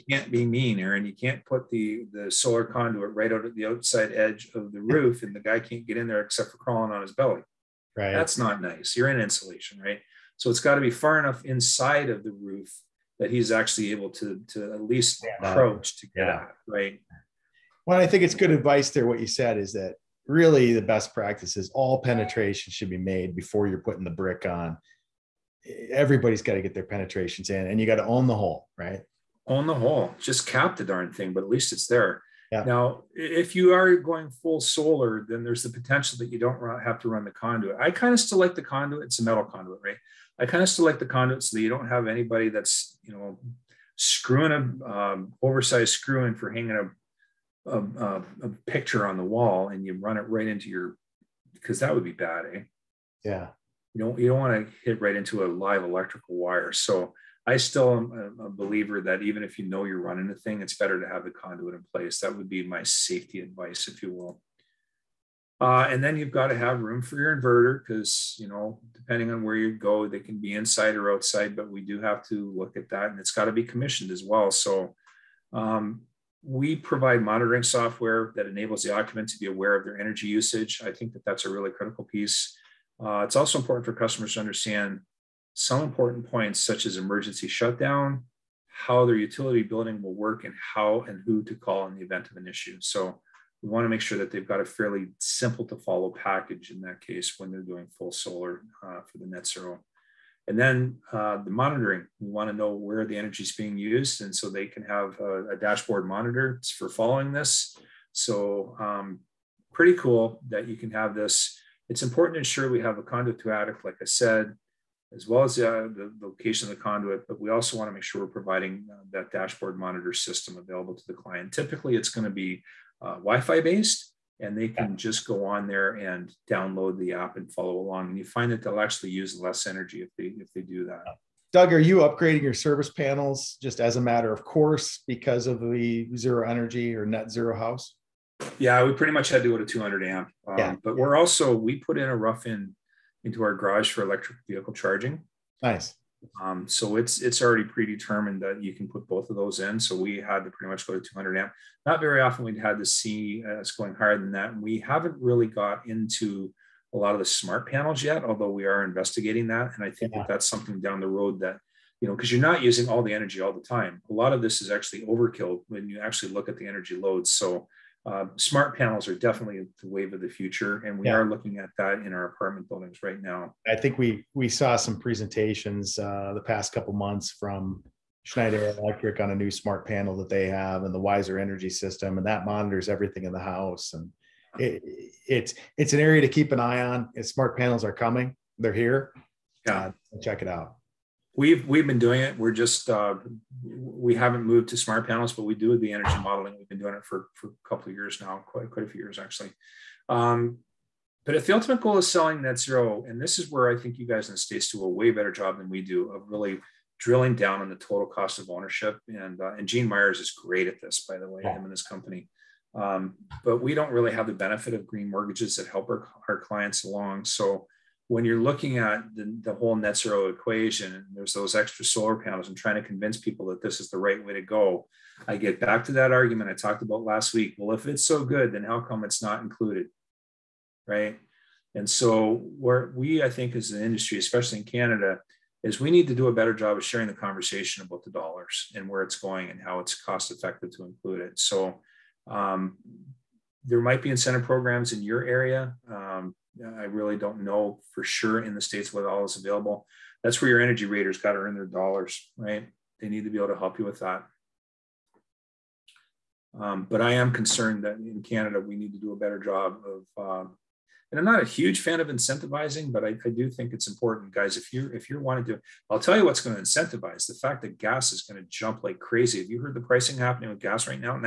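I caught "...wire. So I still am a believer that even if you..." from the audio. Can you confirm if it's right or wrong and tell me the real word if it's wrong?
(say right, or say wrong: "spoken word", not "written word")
right.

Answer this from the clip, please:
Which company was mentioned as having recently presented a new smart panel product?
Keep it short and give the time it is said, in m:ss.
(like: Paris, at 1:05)
Schneider Electric, at 2:58.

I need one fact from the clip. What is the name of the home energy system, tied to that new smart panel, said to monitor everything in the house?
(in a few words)
Wiser Energy System.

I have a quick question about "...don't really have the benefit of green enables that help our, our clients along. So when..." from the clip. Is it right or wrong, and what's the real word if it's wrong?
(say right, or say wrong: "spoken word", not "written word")
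wrong: "mortgages", not "enables".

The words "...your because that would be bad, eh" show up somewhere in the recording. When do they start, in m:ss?
0:50.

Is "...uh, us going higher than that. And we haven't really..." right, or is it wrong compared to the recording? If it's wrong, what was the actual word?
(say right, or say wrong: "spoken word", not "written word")
right.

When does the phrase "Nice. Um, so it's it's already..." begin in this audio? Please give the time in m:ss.
2:25.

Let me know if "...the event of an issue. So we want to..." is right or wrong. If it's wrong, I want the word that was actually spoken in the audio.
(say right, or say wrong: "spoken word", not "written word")
right.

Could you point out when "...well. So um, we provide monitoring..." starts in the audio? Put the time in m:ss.
1:14.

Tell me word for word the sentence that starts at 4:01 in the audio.
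So, um, there might be incentive programs in your area.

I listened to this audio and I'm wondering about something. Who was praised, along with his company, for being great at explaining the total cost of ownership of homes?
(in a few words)
Gene Myers.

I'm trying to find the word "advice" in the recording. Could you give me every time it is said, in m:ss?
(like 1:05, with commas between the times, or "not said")
0:18, 1:03.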